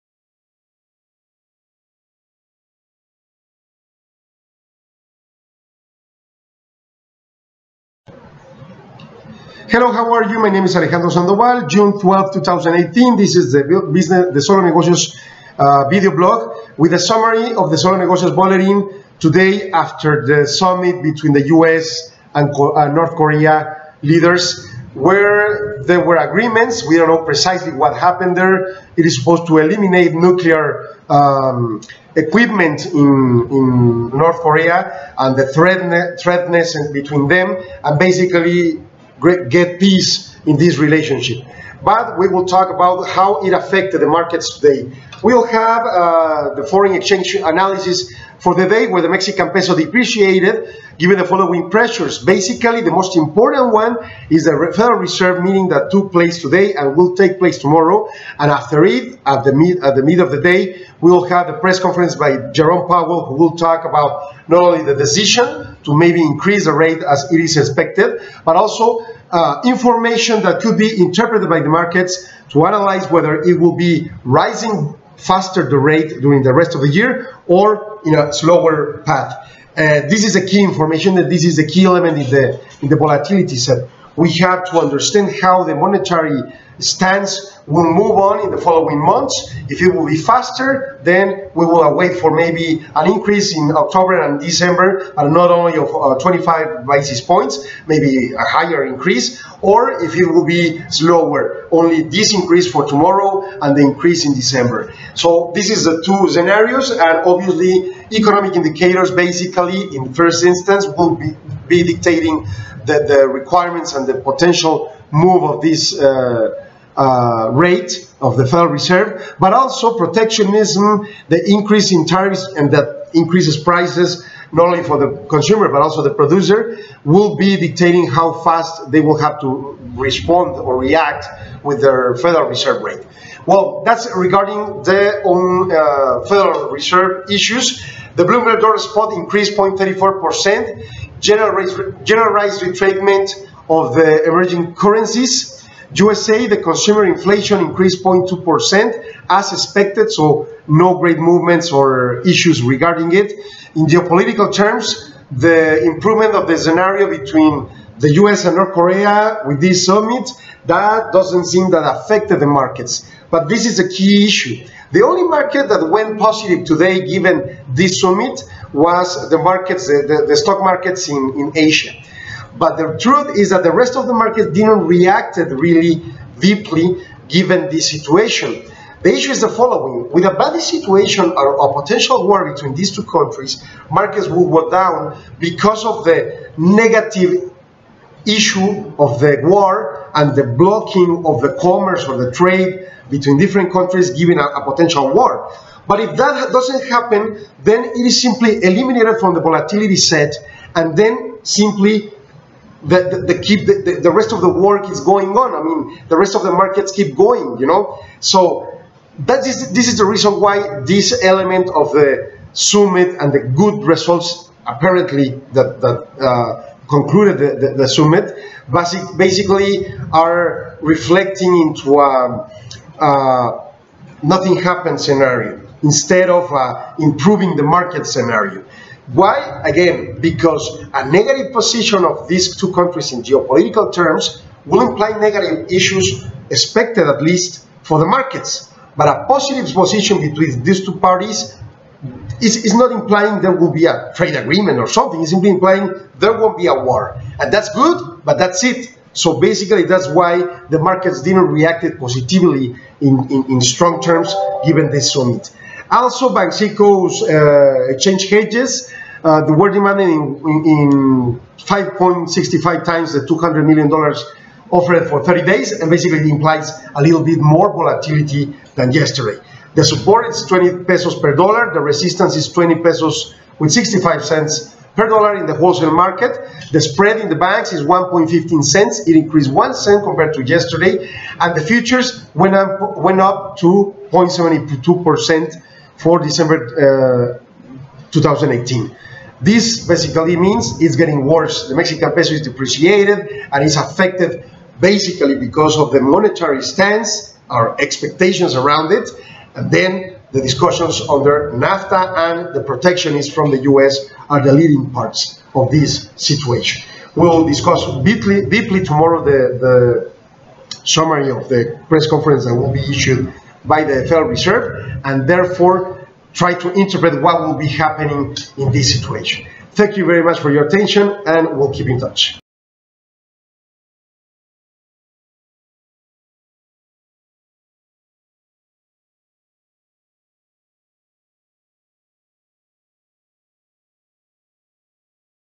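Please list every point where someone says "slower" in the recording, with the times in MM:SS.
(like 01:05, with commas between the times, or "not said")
01:18, 01:40.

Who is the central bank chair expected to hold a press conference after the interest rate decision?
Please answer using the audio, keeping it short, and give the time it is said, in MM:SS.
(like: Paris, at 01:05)
Jerome Powell, at 01:02.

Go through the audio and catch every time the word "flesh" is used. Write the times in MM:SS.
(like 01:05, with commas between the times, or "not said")
not said.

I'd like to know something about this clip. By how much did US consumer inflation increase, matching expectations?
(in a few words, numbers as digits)
0.2%.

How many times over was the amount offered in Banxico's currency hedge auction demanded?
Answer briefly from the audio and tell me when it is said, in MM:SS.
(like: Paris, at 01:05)
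5.65 times, at 04:21.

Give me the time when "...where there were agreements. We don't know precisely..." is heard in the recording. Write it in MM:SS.
00:24.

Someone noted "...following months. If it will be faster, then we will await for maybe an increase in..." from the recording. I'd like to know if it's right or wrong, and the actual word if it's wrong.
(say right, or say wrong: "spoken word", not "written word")
right.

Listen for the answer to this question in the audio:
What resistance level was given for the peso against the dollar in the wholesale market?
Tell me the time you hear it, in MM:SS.
04:32.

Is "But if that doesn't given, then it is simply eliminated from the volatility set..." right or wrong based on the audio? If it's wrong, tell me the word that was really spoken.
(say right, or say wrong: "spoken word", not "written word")
wrong: "happen", not "given".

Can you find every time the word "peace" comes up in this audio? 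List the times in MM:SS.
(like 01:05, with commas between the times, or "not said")
00:39.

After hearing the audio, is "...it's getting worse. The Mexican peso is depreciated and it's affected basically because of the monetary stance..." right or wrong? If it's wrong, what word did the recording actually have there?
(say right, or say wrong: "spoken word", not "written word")
right.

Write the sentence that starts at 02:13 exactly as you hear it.
Well, that's regarding the own uh, Federal Reserve issues.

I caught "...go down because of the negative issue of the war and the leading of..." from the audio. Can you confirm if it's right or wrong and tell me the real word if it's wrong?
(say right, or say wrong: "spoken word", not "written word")
wrong: "blocking", not "leading".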